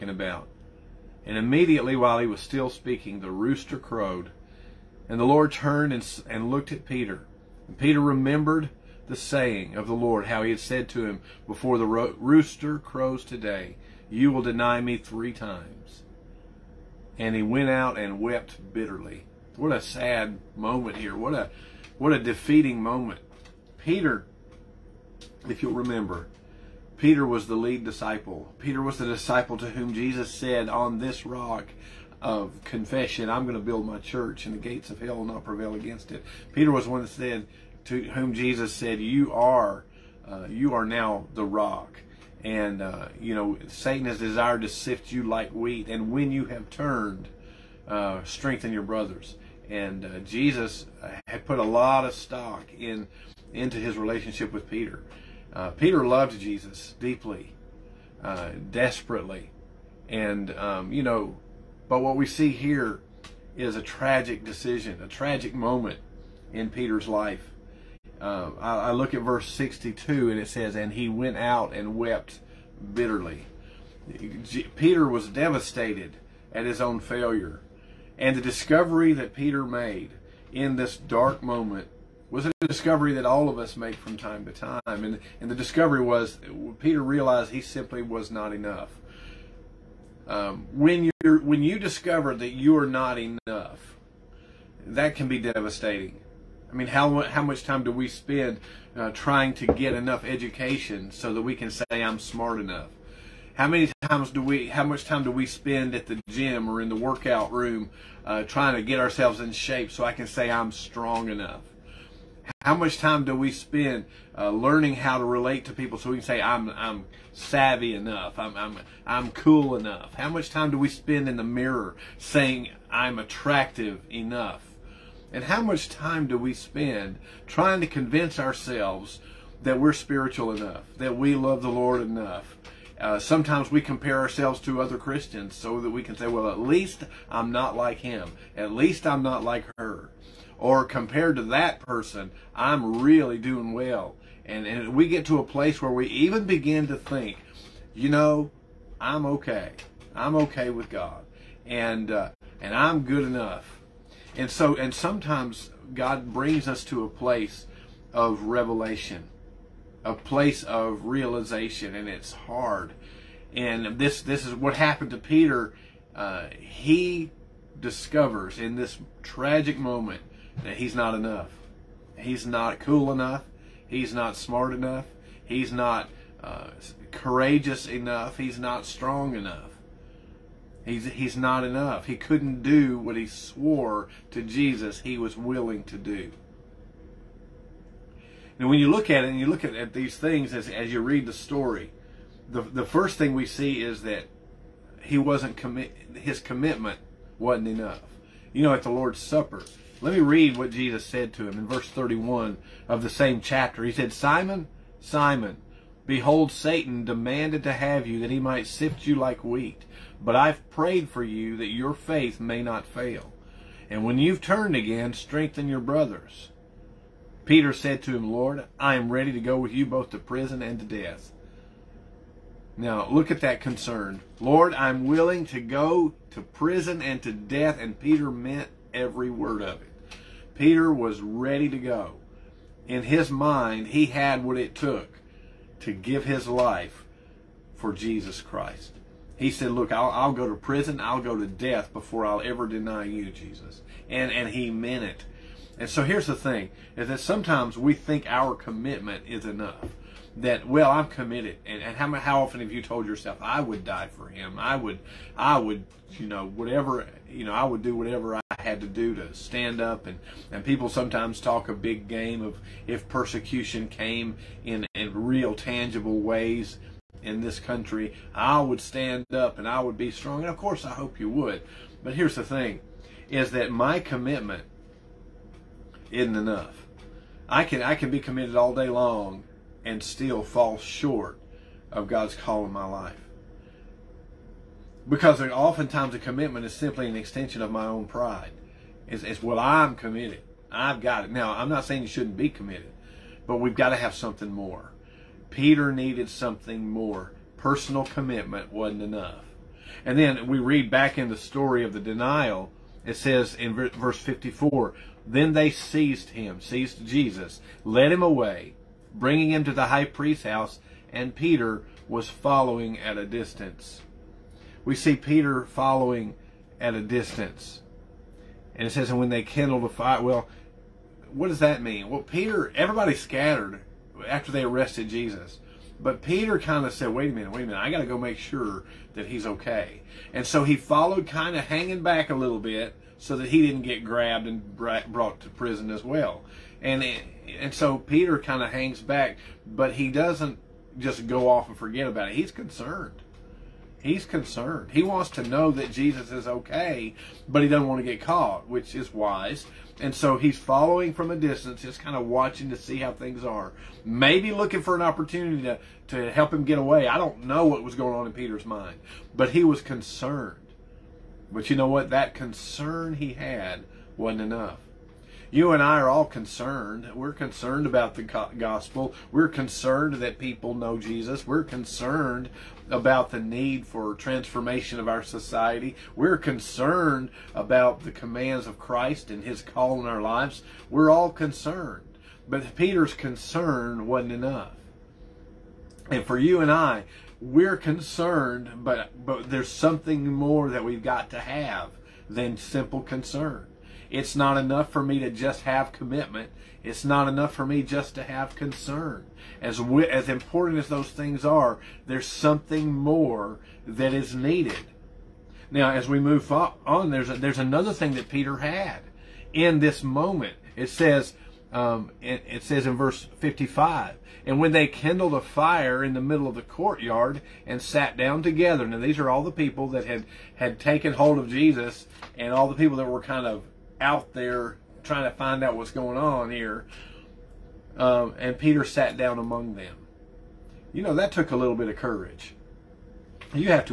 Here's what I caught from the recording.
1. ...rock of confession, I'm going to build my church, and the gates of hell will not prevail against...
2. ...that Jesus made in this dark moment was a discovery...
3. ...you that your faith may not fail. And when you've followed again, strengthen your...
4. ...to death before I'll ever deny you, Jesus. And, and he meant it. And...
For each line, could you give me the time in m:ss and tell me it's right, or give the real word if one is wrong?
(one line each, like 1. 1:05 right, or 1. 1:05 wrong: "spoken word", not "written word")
1. 0:31 right
2. 1:19 wrong: "Peter", not "Jesus"
3. 3:31 wrong: "turned", not "followed"
4. 4:01 right.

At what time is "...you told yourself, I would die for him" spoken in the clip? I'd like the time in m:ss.
4:12.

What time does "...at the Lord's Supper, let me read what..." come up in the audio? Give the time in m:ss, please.
3:18.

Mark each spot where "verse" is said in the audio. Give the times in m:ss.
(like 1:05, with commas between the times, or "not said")
1:09, 3:21, 5:03, 6:52.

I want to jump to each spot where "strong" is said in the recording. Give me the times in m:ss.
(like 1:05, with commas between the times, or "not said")
1:50, 2:58, 4:30.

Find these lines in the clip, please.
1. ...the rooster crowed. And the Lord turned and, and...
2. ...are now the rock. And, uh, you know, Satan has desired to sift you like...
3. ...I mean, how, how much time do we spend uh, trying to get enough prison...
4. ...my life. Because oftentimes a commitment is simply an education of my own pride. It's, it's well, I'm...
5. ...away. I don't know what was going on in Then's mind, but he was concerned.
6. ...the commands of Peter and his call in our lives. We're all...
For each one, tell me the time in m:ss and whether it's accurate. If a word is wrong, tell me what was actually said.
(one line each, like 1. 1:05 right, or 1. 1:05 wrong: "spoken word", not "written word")
1. 0:03 right
2. 0:40 right
3. 1:36 wrong: "education", not "prison"
4. 4:42 wrong: "extension", not "education"
5. 5:56 wrong: "Peter", not "Then"
6. 6:18 wrong: "Christ", not "Peter".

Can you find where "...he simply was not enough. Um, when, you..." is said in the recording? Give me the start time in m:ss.
1:27.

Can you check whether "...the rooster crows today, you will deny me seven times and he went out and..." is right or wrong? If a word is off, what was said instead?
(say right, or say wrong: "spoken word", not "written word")
wrong: "three", not "seven".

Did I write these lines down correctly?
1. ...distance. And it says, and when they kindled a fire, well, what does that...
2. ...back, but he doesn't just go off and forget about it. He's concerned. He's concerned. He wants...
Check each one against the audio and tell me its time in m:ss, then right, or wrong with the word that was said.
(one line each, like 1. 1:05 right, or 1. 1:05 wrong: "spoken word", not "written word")
1. 5:17 right
2. 5:39 right.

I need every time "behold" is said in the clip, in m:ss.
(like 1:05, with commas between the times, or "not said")
3:26.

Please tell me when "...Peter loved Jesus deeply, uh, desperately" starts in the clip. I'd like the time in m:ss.
0:55.